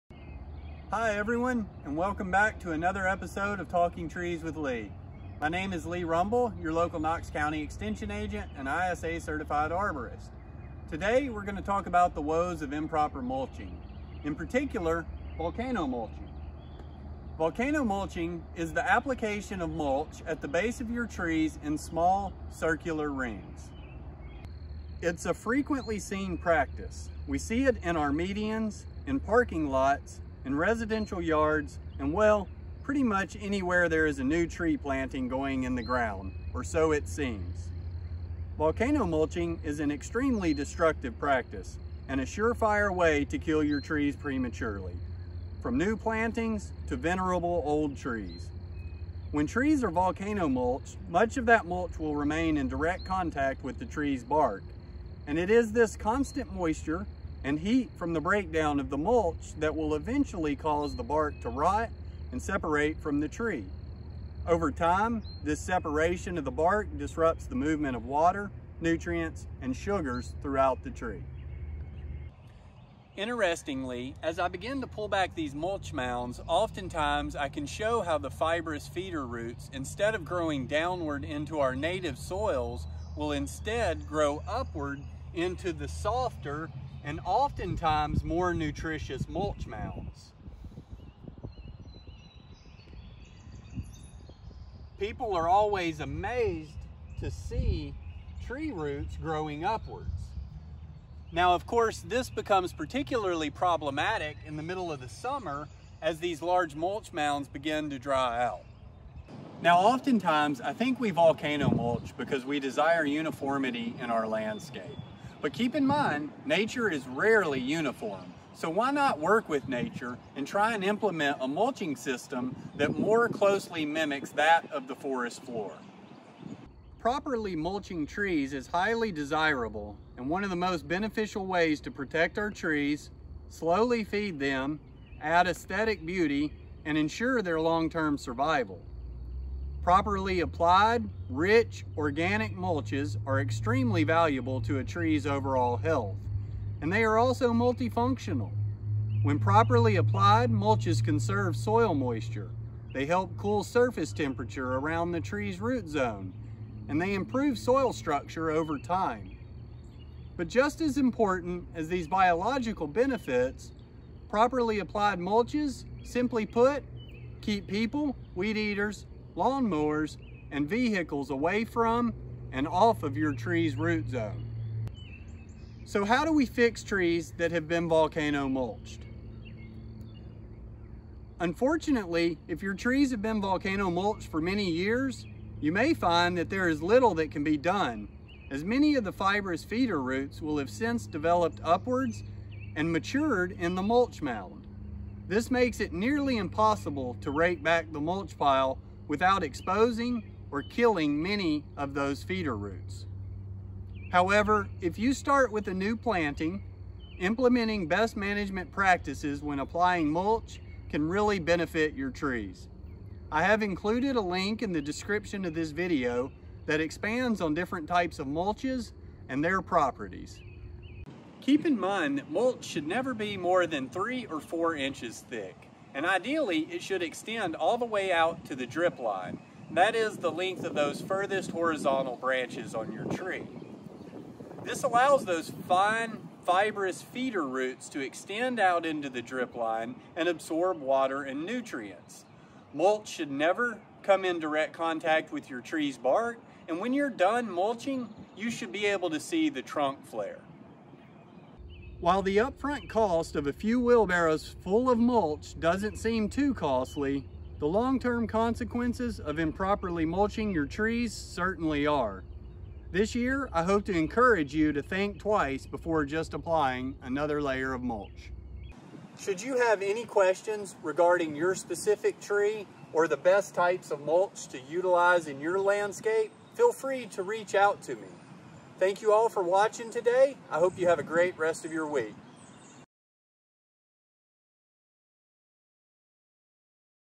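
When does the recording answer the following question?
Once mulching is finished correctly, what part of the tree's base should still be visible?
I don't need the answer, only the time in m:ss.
4:09.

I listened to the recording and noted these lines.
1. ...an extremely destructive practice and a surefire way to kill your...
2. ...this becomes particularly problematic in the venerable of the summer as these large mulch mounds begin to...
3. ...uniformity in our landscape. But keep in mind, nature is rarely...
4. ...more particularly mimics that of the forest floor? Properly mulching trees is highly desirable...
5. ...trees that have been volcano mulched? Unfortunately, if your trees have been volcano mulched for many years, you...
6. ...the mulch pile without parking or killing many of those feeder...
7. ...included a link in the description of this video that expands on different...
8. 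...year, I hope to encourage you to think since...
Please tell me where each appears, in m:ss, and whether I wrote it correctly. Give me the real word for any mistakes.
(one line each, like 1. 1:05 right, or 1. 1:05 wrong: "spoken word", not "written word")
1. 0:39 right
2. 1:42 wrong: "middle", not "venerable"
3. 1:53 right
4. 2:02 wrong: "closely", not "particularly"
5. 2:56 right
6. 3:17 wrong: "exposing", not "parking"
7. 3:33 right
8. 4:23 wrong: "twice", not "since".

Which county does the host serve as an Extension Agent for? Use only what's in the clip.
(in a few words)
Knox County.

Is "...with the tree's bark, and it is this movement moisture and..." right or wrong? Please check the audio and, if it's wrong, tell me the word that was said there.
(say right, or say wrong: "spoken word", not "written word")
wrong: "constant", not "movement".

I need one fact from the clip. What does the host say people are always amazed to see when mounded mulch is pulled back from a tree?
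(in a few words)
Tree roots growing upwards.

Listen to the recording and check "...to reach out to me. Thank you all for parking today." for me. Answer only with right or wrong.
wrong.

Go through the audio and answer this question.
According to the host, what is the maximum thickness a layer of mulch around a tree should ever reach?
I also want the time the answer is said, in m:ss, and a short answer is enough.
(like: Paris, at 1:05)
3 or 4 inches, at 3:43.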